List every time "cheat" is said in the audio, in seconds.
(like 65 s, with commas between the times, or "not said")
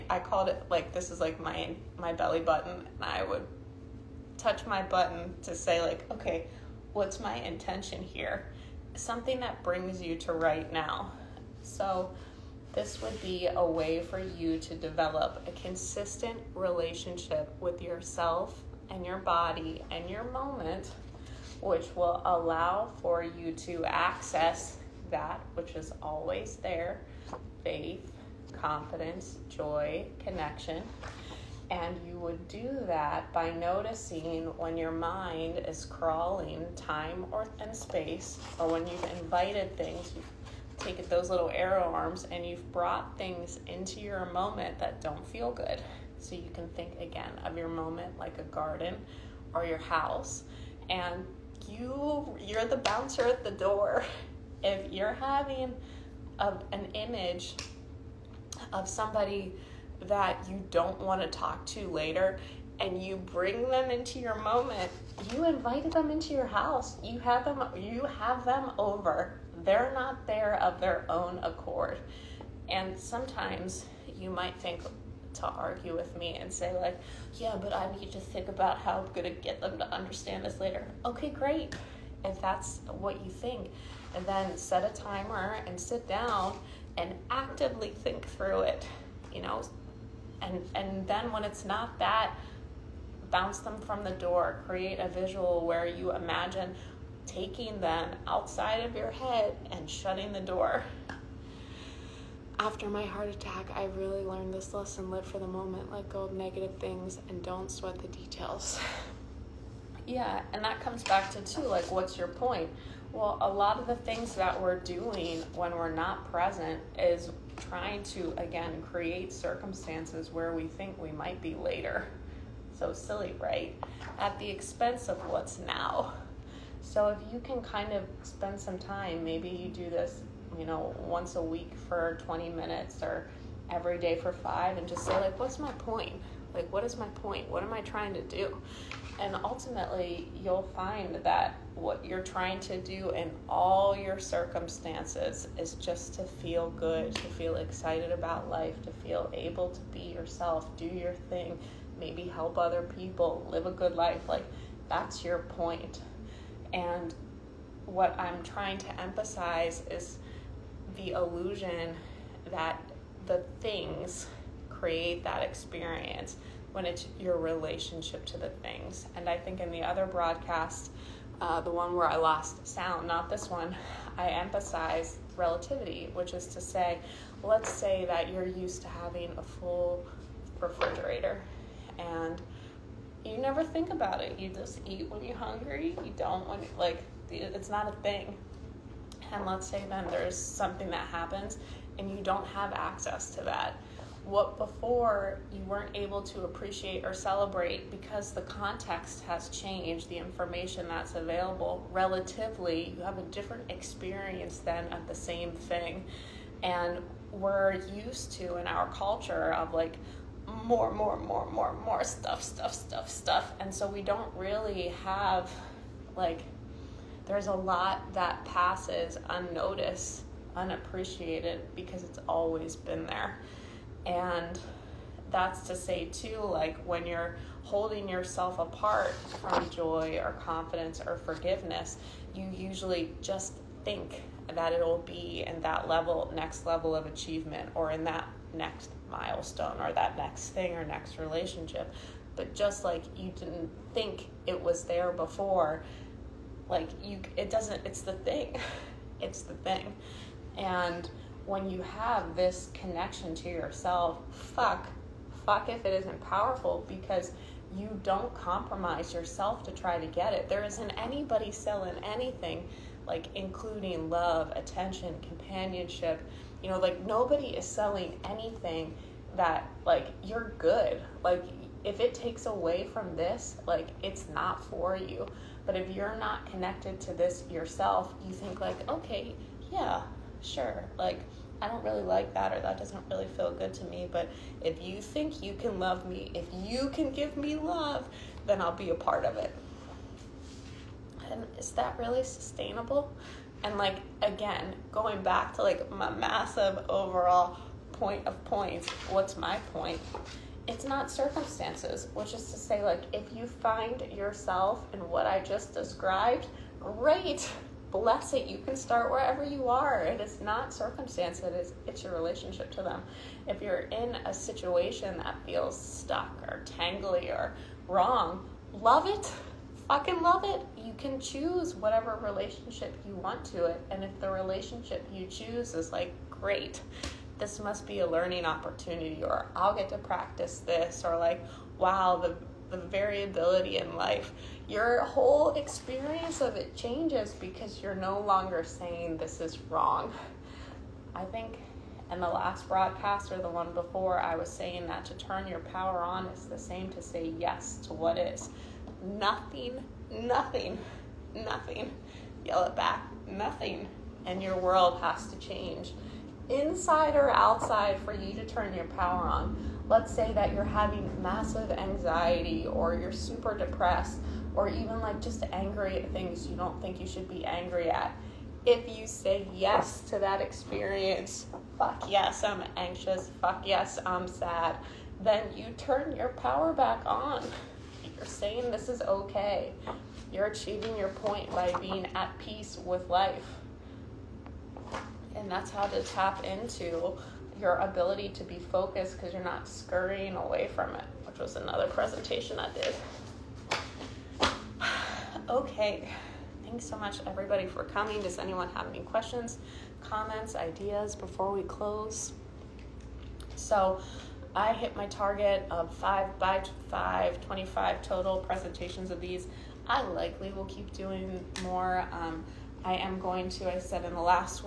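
not said.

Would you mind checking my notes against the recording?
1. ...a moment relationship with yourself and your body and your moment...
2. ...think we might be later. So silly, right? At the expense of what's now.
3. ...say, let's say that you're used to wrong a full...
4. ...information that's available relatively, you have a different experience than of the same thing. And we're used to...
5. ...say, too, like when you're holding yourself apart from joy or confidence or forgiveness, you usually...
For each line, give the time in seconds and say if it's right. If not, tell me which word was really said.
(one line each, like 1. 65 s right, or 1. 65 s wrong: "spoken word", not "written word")
1. 15 s wrong: "consistent", not "moment"
2. 120 s right
3. 176 s wrong: "having", not "wrong"
4. 200 s right
5. 225 s right.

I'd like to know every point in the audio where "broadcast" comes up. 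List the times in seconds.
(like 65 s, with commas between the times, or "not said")
170 s, 342 s.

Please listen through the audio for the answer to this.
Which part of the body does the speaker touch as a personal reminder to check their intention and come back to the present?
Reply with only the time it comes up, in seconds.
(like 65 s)
2 s.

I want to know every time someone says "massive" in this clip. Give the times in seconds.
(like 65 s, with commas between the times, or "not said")
296 s, 361 s.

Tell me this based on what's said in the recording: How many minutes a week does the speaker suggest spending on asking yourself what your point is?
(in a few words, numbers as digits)
20 minutes.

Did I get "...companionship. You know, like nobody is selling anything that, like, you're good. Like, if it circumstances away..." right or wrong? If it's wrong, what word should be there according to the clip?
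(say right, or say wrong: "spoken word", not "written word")
wrong: "takes", not "circumstances".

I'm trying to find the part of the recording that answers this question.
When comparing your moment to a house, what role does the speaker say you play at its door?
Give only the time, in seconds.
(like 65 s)
52 s.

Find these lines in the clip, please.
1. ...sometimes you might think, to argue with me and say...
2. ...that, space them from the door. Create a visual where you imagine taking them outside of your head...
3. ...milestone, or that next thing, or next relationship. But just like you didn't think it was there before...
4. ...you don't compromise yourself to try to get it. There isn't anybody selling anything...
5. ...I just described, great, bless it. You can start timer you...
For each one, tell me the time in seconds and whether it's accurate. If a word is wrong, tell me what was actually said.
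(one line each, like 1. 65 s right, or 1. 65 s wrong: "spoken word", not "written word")
1. 72 s right
2. 91 s wrong: "bounce", not "space"
3. 239 s right
4. 257 s right
5. 305 s wrong: "wherever", not "timer".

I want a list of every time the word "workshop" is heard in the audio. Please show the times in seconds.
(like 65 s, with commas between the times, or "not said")
not said.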